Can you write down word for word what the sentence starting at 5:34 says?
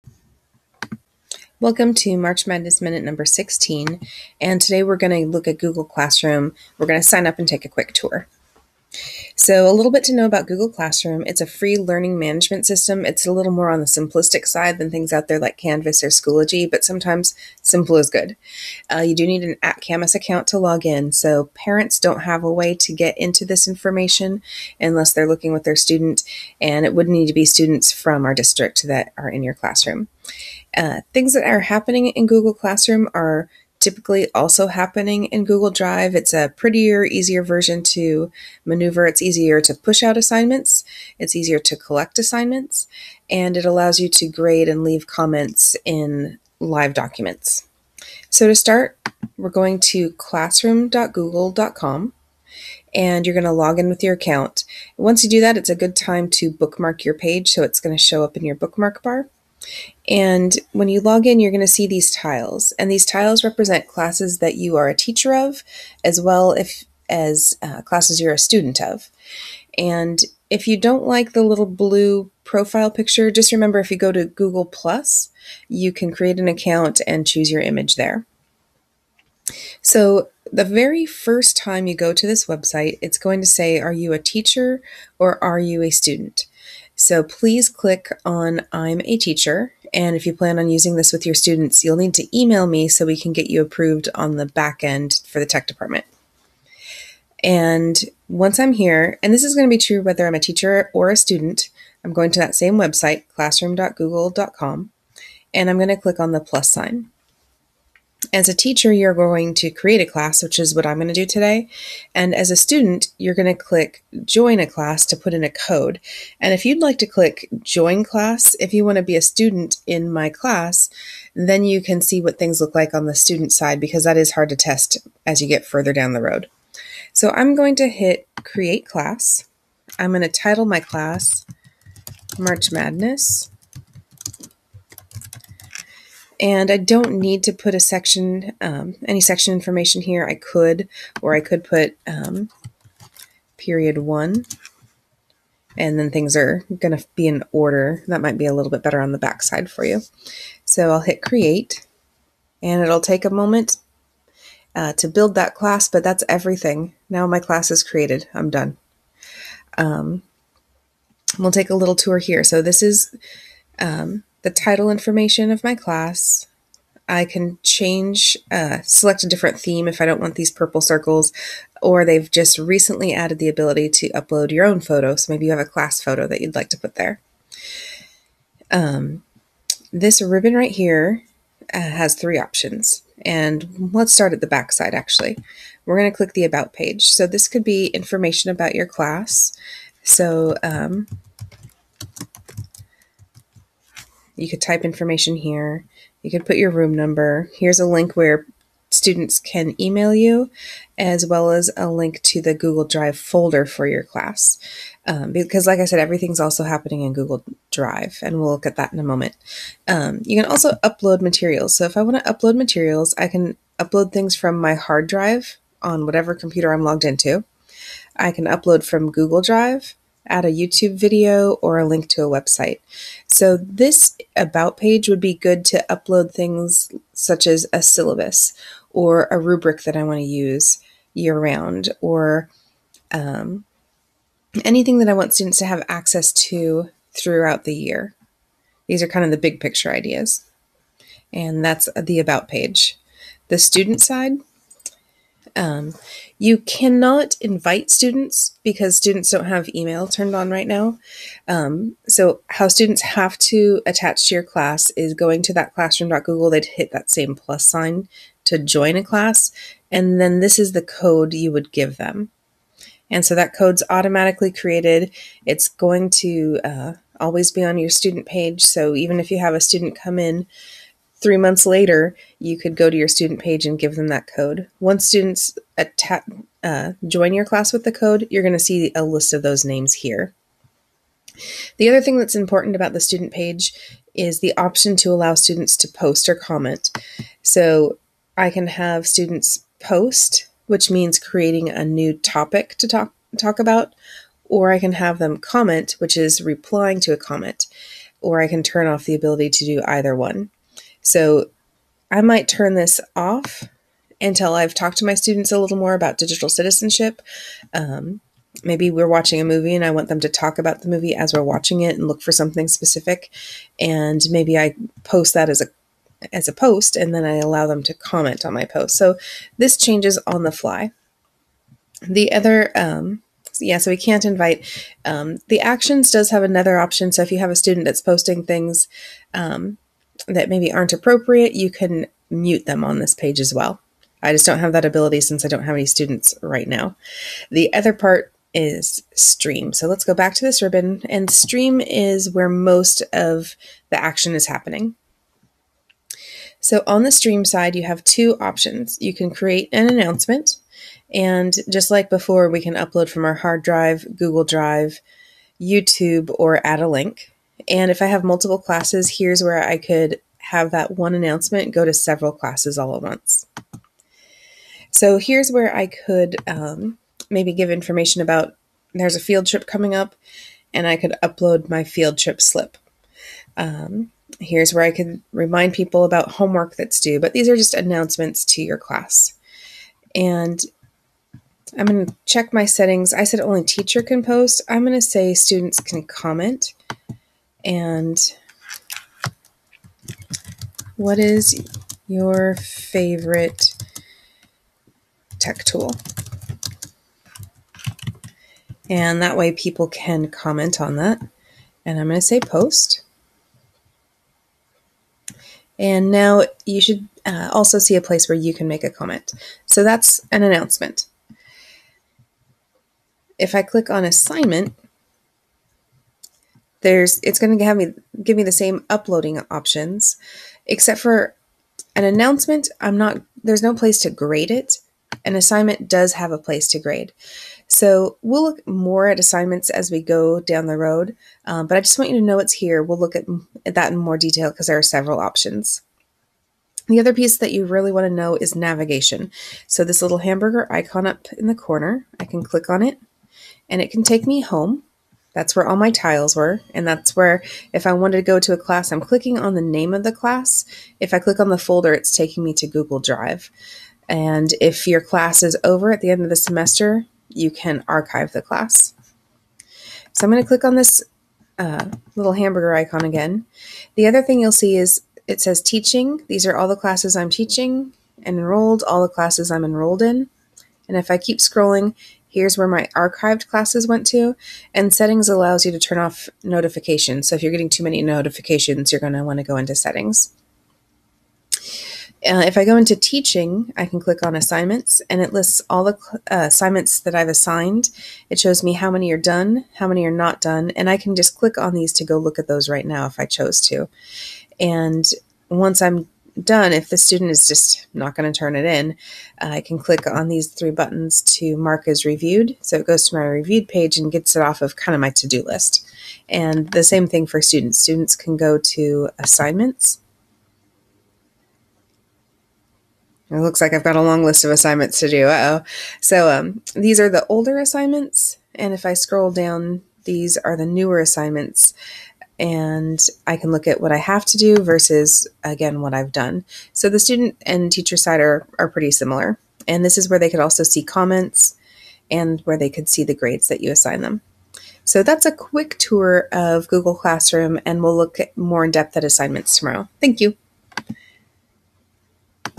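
I just don't have that ability since I don't have any students right now.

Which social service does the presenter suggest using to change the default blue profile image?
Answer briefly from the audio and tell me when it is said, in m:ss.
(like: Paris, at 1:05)
Google Plus, at 1:14.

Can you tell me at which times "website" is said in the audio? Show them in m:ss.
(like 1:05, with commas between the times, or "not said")
1:22, 1:42, 3:42.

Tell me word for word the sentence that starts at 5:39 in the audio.
So let's go back to this ribbon and stream is where most of the action is happening.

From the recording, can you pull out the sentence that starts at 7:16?
The other piece that you really want to know is navigation.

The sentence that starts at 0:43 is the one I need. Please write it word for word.
And it allows you to grade and leave comments in live documents.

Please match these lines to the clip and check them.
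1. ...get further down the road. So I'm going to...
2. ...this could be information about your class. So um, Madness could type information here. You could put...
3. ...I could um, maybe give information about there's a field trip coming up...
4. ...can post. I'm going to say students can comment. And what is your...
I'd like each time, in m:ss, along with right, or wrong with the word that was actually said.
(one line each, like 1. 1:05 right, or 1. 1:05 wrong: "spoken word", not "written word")
1. 2:05 right
2. 3:07 wrong: "You", not "Madness"
3. 6:05 right
4. 6:24 right.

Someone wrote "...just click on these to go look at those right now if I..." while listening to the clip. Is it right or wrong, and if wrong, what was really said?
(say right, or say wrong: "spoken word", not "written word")
right.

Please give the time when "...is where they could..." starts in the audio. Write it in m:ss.
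8:49.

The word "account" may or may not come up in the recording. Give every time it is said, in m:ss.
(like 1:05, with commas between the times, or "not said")
0:20, 0:54, 1:16.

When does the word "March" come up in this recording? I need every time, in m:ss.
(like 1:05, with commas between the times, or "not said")
0:02, 2:12.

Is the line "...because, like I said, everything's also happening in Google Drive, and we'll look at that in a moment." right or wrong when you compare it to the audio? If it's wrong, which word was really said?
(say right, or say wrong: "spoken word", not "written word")
right.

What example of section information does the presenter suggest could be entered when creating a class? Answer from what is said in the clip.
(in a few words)
period one.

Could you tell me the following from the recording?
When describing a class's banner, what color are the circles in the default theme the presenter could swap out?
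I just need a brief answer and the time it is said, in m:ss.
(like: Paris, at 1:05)
purple, at 2:50.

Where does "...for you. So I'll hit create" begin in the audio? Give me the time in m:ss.
2:29.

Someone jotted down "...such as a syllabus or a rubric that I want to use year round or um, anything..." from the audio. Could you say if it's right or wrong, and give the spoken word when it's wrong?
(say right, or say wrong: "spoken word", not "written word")
right.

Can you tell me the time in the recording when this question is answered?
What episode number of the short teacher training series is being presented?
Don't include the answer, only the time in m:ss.
0:03.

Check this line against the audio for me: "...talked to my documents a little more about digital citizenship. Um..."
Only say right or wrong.
wrong.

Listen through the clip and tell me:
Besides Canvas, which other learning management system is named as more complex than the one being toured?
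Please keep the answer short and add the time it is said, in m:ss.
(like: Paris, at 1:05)
Schoology, at 0:16.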